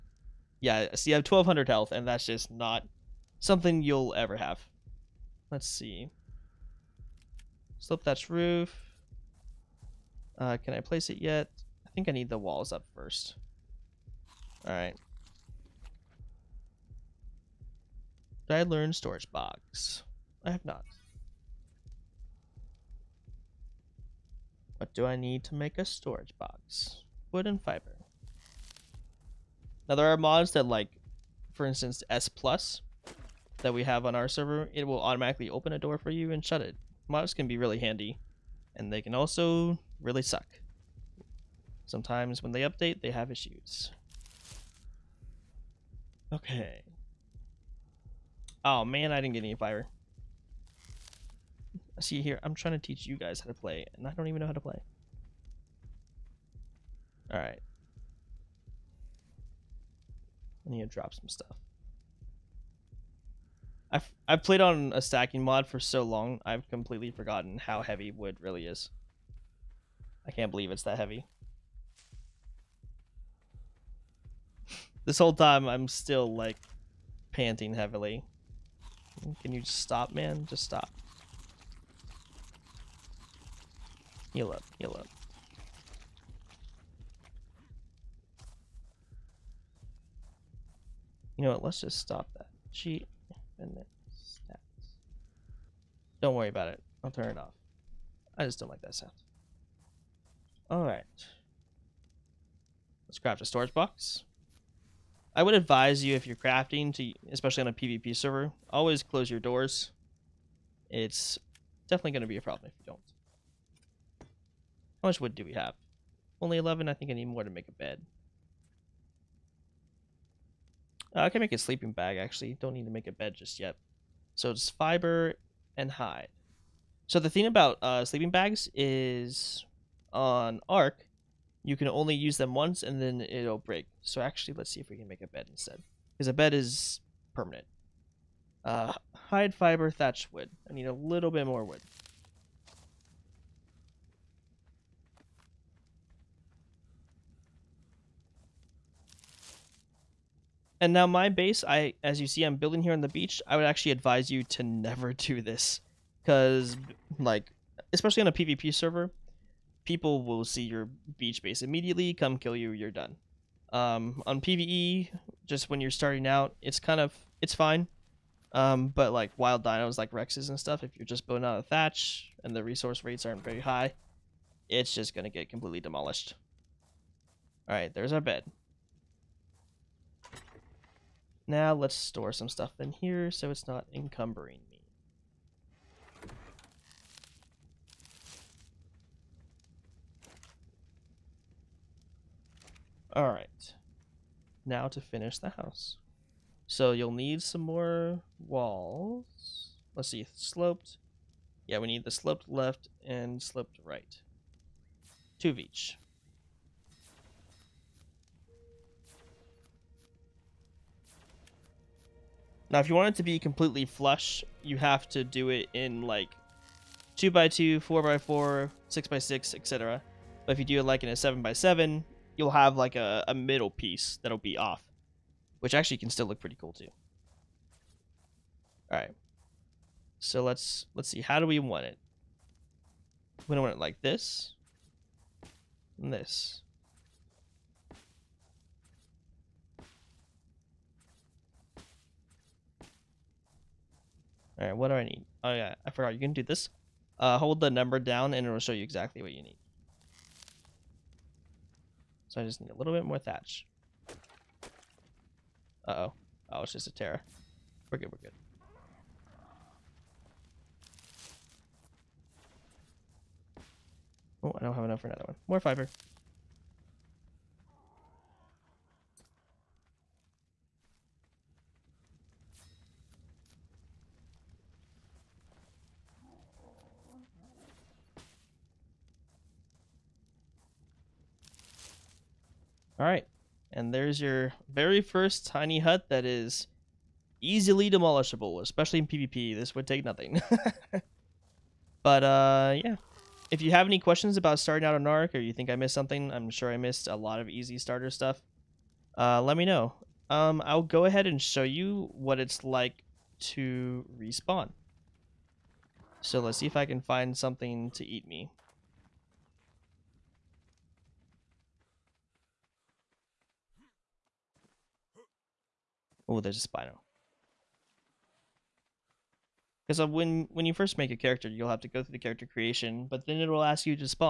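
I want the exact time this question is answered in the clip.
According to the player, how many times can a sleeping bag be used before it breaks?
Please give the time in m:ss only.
2:12.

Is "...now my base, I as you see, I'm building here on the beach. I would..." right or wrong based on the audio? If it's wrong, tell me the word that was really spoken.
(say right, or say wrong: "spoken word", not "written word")
right.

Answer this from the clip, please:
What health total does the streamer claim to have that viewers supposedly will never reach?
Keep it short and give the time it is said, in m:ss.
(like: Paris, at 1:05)
1200, at 0:01.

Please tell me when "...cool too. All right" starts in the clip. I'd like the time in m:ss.
3:46.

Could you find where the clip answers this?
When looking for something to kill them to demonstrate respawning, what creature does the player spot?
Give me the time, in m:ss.
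5:16.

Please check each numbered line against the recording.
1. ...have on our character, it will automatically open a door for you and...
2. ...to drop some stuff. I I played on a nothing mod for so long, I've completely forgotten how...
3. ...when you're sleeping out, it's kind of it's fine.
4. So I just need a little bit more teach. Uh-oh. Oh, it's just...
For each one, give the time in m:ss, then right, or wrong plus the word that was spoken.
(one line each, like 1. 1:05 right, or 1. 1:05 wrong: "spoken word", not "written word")
1. 0:33 wrong: "server", not "character"
2. 1:00 wrong: "stacking", not "nothing"
3. 2:45 wrong: "starting", not "sleeping"
4. 4:12 wrong: "thatch", not "teach".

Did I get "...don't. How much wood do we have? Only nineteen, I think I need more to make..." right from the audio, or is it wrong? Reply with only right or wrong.
wrong.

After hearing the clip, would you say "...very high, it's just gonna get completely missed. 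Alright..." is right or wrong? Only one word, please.
wrong.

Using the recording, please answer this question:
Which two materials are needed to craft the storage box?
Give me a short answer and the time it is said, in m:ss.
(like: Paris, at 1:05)
Wood and fiber, at 0:27.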